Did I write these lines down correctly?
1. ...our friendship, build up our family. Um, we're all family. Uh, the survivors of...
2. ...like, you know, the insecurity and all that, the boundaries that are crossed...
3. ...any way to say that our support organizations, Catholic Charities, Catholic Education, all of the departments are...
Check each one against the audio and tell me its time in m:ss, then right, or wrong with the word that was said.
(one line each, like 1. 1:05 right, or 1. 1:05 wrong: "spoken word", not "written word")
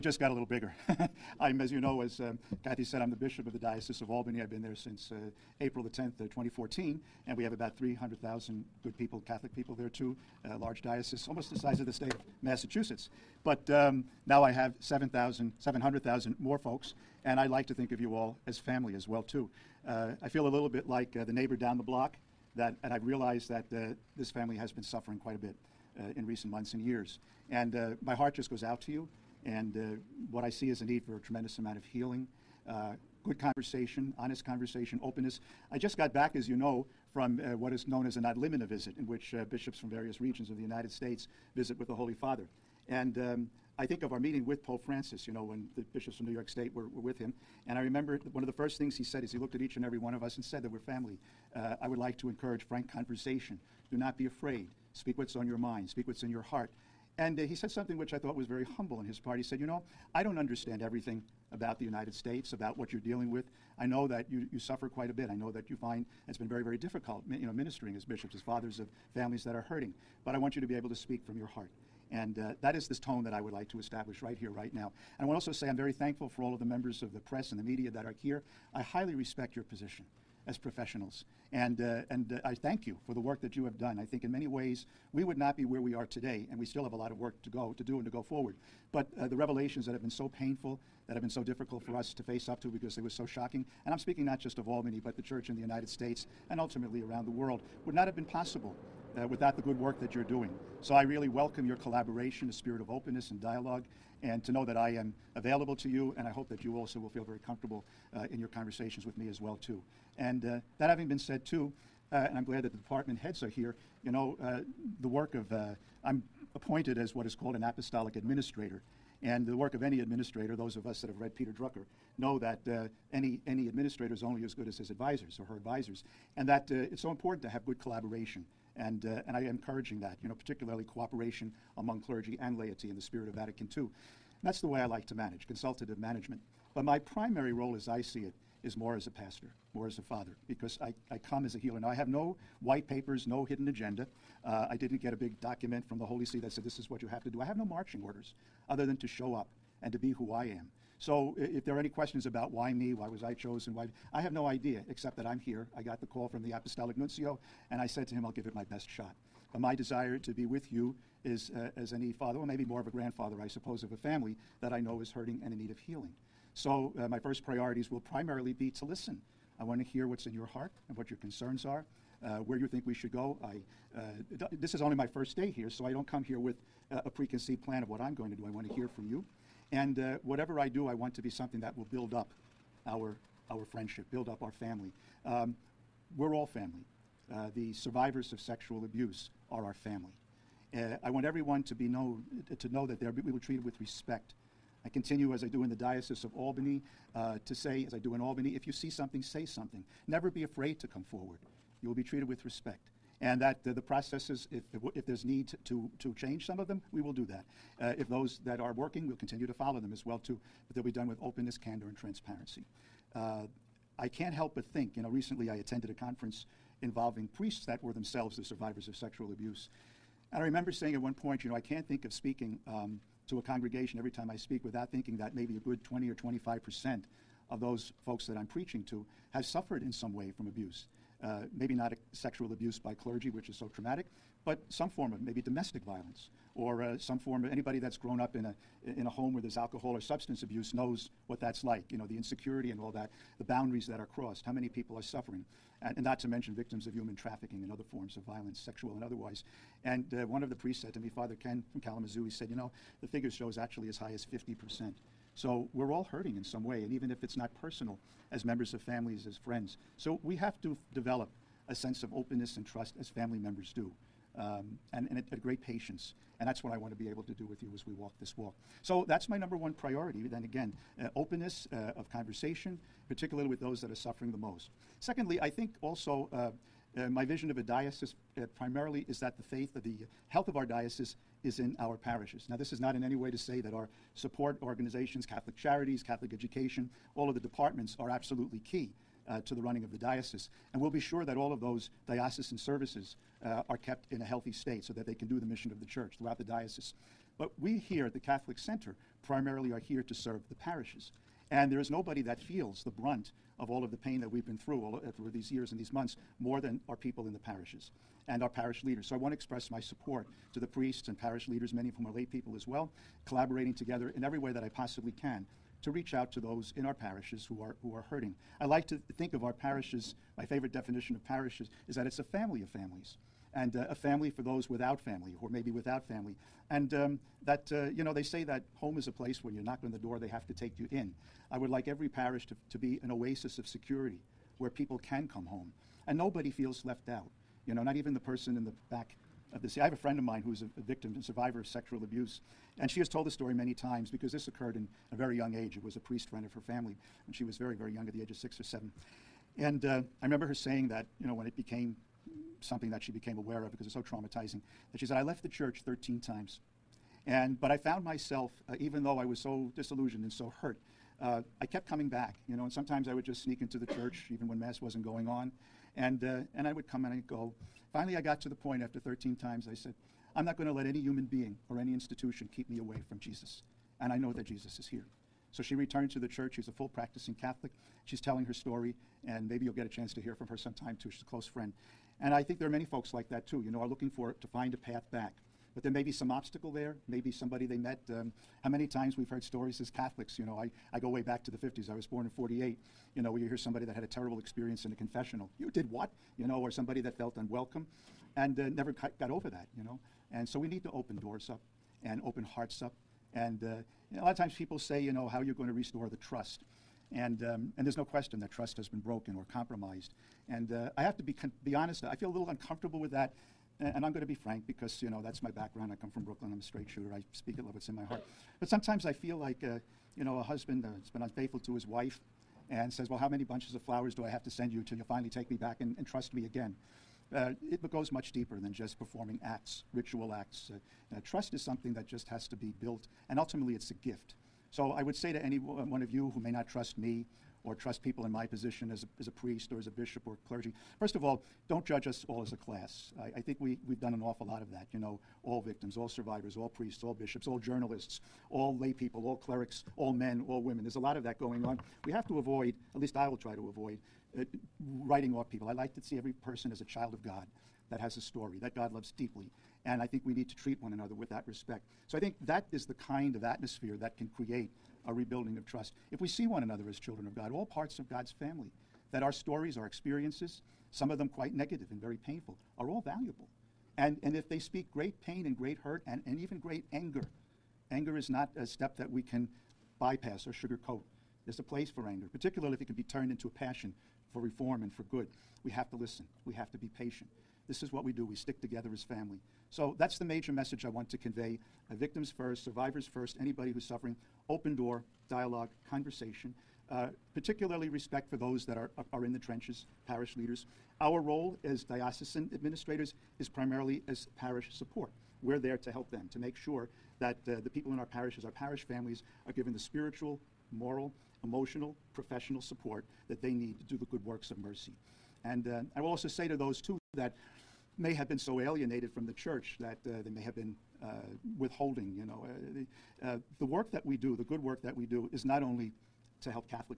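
1. 3:03 right
2. 4:01 right
3. 4:43 right.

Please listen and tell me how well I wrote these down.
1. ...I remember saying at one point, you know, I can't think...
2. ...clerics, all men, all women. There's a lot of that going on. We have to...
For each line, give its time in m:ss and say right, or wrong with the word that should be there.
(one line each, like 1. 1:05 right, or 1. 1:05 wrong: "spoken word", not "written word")
1. 3:40 right
2. 7:29 right.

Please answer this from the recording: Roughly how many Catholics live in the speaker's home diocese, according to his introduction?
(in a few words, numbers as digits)
300,000.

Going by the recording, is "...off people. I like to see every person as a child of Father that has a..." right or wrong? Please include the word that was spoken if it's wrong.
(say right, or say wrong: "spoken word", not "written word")
wrong: "God", not "Father".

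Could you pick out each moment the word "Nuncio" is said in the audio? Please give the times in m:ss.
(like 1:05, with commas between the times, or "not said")
2:36.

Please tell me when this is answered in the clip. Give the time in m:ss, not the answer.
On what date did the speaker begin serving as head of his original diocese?
0:05.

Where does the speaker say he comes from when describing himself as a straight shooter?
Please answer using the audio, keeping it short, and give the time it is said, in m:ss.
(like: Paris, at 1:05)
Brooklyn, at 6:56.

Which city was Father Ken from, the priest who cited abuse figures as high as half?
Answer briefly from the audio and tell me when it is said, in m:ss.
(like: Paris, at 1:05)
Kalamazoo, at 4:11.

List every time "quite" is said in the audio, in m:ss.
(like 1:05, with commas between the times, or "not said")
0:25, 1:04, 7:51.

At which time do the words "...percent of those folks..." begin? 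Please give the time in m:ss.
3:46.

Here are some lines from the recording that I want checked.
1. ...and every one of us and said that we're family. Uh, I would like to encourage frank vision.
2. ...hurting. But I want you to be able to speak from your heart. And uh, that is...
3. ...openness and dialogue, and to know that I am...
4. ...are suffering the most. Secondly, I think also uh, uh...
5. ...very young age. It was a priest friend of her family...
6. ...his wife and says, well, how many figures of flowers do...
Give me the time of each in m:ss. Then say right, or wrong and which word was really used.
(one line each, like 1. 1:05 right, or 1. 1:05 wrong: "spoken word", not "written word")
1. 0:49 wrong: "conversation", not "vision"
2. 1:09 right
3. 1:42 right
4. 4:33 right
5. 5:45 right
6. 7:01 wrong: "bunches", not "figures".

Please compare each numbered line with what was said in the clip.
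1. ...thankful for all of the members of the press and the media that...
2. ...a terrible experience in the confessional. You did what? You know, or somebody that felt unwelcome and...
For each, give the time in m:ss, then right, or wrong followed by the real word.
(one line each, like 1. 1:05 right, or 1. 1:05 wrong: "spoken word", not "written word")
1. 1:15 right
2. 6:34 right.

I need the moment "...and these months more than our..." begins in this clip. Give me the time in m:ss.
5:05.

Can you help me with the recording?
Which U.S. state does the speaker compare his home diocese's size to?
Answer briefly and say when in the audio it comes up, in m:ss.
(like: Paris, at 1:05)
Massachusetts, at 0:12.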